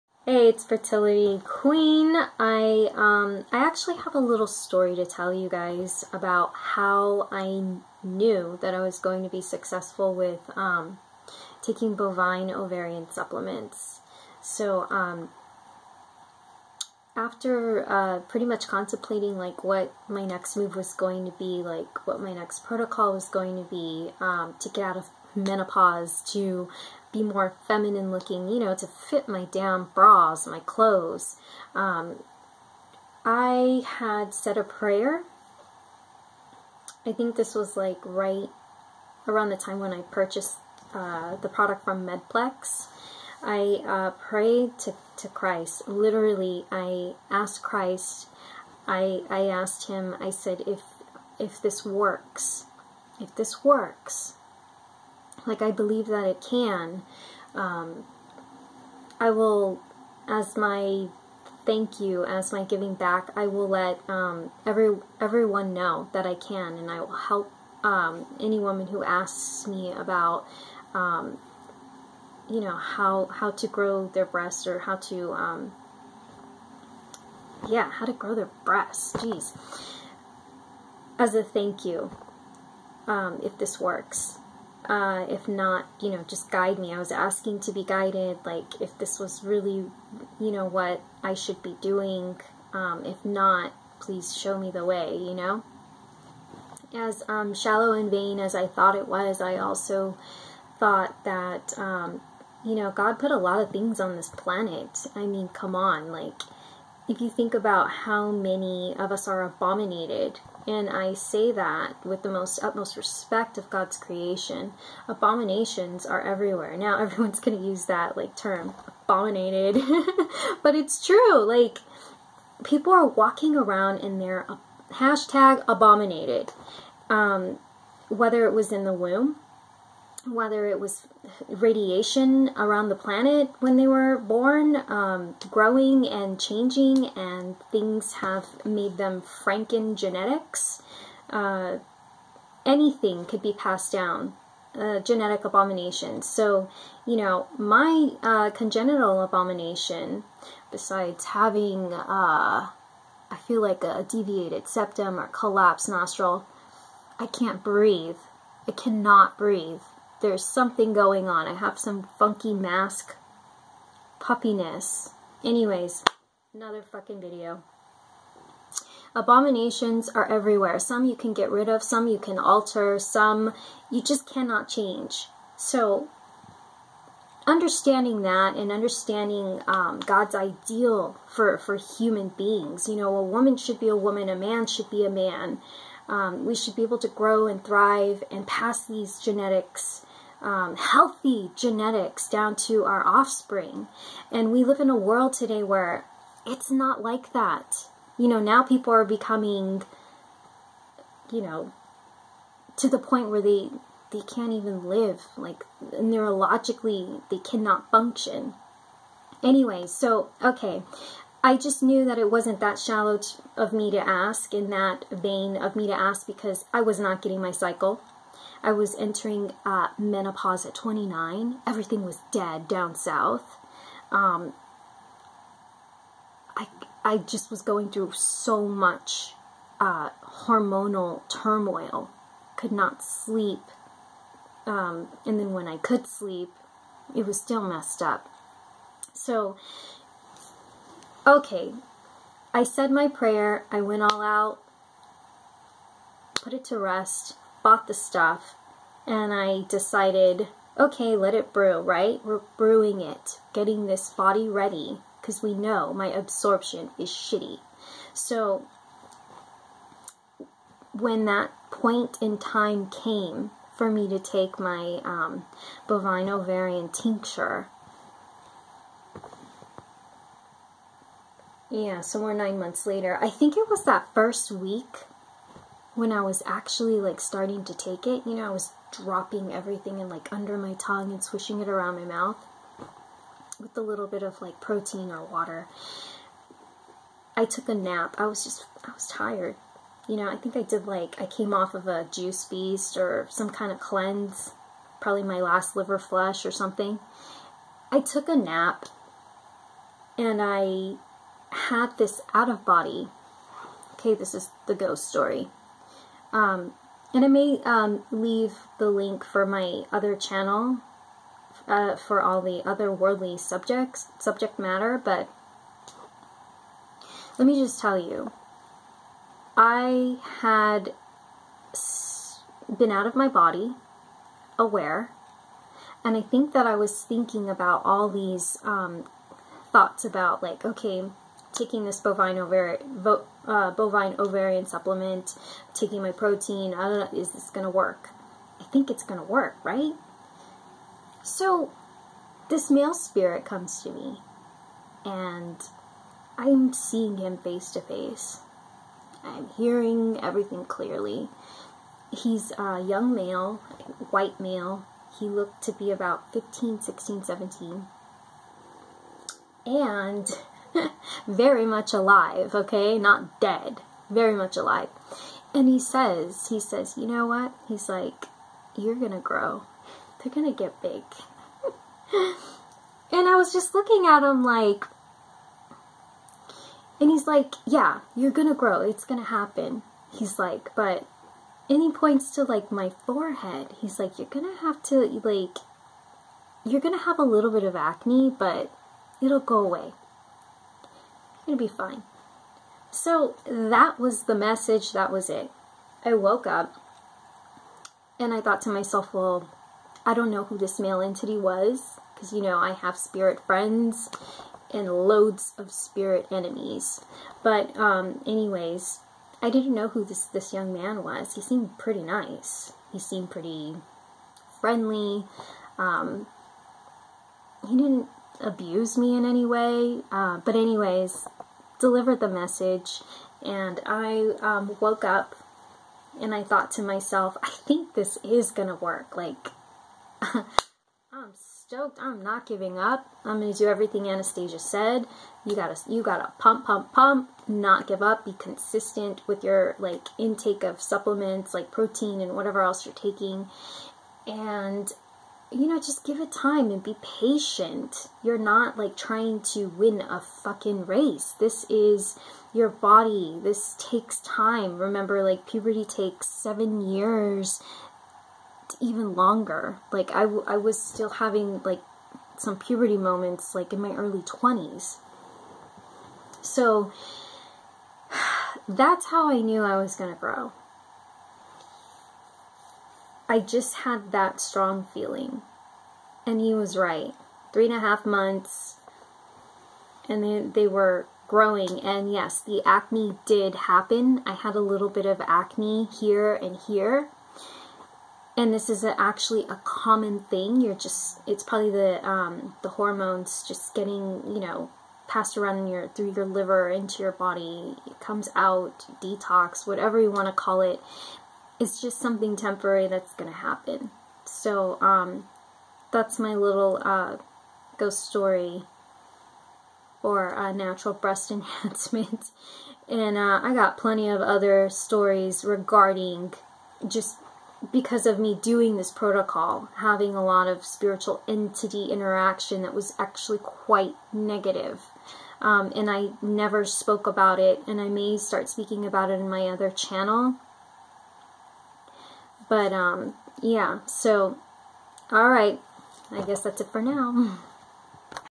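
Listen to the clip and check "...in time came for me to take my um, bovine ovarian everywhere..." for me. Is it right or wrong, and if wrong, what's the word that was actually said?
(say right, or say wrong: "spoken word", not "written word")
wrong: "tincture", not "everywhere".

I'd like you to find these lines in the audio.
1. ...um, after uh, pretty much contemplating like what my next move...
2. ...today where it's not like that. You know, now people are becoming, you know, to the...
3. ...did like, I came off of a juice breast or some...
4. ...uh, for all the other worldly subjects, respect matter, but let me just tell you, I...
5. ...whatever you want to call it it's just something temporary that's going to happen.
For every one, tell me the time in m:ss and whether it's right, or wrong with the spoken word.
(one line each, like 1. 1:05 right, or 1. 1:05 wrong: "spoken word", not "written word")
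1. 0:14 right
2. 3:15 right
3. 4:50 wrong: "feast", not "breast"
4. 5:11 wrong: "subject", not "respect"
5. 8:19 right.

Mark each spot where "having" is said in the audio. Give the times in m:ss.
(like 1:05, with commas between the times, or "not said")
2:31, 7:41, 8:39.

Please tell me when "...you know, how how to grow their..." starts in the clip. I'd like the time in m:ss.
1:12.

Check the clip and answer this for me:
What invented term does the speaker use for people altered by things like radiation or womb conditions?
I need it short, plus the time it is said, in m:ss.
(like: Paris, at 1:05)
Franken genetics, at 2:19.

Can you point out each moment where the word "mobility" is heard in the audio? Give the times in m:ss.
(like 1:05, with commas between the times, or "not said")
not said.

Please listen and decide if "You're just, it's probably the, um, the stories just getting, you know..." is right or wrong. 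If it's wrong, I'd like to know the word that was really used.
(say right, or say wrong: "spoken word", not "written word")
wrong: "hormones", not "stories".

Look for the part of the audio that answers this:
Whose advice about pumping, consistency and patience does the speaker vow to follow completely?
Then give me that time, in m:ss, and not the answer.
7:14.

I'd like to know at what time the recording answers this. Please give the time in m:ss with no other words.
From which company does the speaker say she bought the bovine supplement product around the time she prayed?
0:42.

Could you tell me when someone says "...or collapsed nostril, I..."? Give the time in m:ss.
2:35.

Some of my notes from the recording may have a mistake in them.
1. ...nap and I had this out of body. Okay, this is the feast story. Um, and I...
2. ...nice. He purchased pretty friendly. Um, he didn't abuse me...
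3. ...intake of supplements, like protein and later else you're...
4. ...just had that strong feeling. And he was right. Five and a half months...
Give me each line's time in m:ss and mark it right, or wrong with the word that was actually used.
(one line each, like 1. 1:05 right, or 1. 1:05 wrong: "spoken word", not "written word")
1. 4:58 wrong: "ghost", not "feast"
2. 6:52 wrong: "seemed", not "purchased"
3. 7:20 wrong: "whatever", not "later"
4. 7:53 wrong: "Three", not "Five".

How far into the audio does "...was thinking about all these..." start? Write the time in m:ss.
5:26.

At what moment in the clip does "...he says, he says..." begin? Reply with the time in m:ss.
6:05.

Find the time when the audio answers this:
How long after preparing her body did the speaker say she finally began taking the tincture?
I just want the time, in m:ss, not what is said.
4:32.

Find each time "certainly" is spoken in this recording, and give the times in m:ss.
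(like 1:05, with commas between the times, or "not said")
not said.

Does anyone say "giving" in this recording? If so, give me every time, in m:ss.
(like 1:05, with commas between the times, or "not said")
1:02, 7:12.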